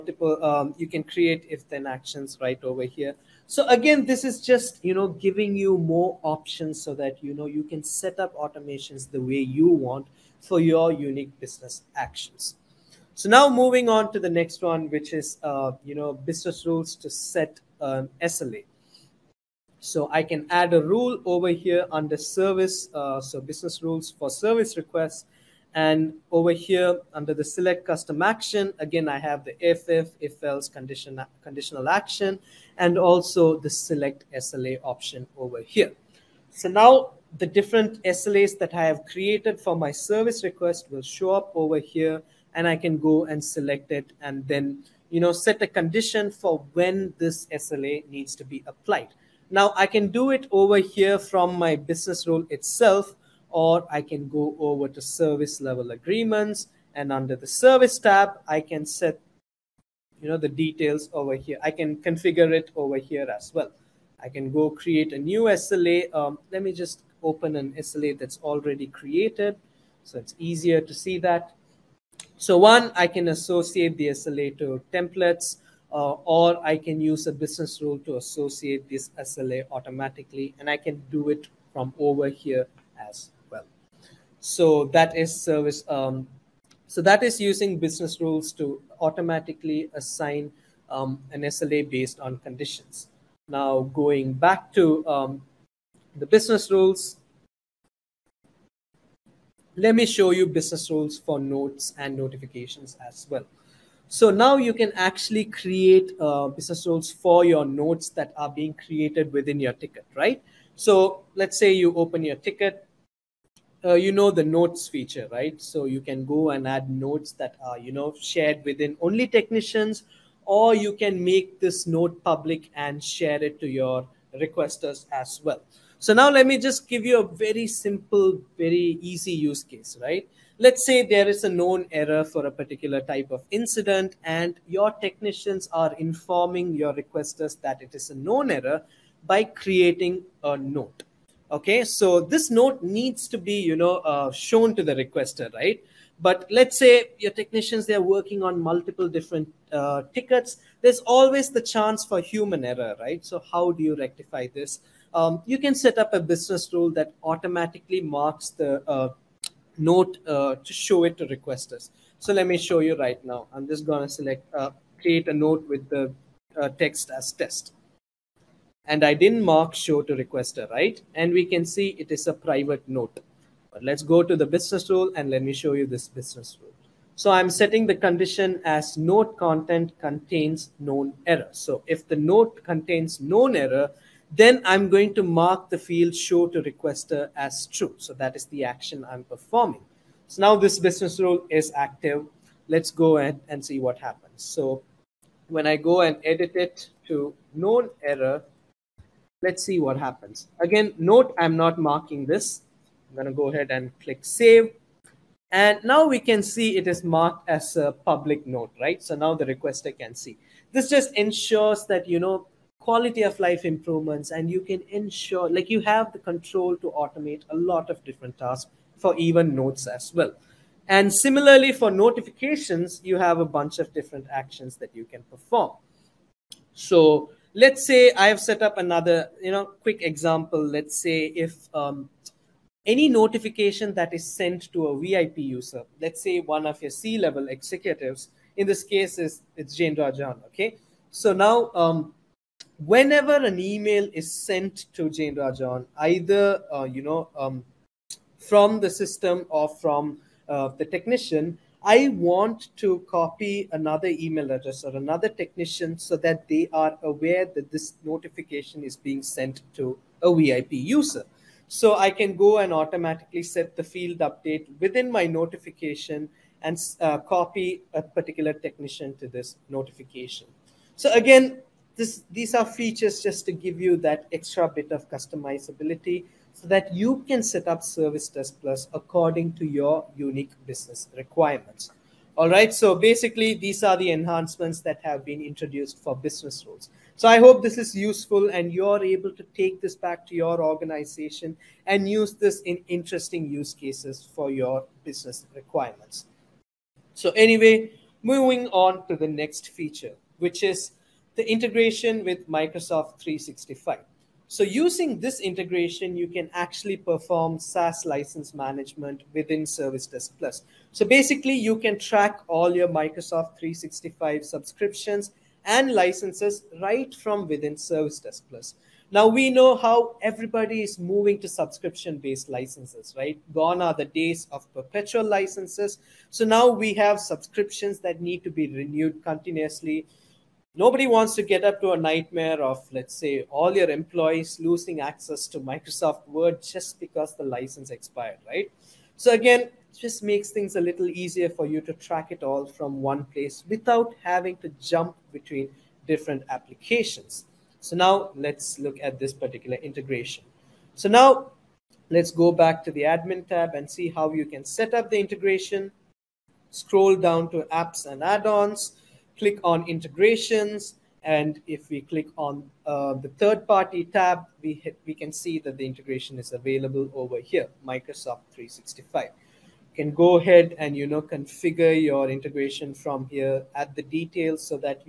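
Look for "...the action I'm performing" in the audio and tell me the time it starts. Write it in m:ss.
3:08.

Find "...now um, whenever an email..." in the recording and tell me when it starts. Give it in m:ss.
4:01.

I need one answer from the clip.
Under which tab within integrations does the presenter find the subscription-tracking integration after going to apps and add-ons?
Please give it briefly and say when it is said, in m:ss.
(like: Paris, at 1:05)
third party, at 6:03.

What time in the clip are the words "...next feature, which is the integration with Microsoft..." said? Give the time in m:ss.
4:59.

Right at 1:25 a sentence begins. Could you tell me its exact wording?
Um, so that is using business rules to automatically assign um, an SLA based on conditions.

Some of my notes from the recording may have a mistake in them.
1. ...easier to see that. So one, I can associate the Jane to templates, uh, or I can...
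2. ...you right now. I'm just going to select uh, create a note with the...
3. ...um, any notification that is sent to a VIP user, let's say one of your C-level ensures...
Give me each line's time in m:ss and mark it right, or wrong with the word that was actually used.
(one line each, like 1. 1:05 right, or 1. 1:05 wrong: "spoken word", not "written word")
1. 1:10 wrong: "SLA", not "Jane"
2. 2:42 right
3. 3:51 wrong: "executives", not "ensures".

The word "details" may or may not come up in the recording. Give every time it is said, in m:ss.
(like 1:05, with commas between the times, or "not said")
1:00, 6:14.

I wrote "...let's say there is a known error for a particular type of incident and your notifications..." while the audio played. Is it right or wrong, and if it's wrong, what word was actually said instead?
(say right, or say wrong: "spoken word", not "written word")
wrong: "technicians", not "notifications".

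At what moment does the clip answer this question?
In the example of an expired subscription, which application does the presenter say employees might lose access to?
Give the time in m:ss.
5:35.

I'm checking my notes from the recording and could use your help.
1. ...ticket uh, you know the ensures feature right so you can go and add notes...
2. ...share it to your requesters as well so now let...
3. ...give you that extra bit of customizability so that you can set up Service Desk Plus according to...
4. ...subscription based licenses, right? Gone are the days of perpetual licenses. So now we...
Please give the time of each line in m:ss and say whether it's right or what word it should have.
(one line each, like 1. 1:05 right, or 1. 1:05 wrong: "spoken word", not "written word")
1. 1:52 wrong: "notes", not "ensures"
2. 2:03 right
3. 4:33 right
4. 5:21 right.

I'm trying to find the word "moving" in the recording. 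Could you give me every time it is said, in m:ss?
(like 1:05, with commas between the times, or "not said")
0:13, 4:58, 5:20.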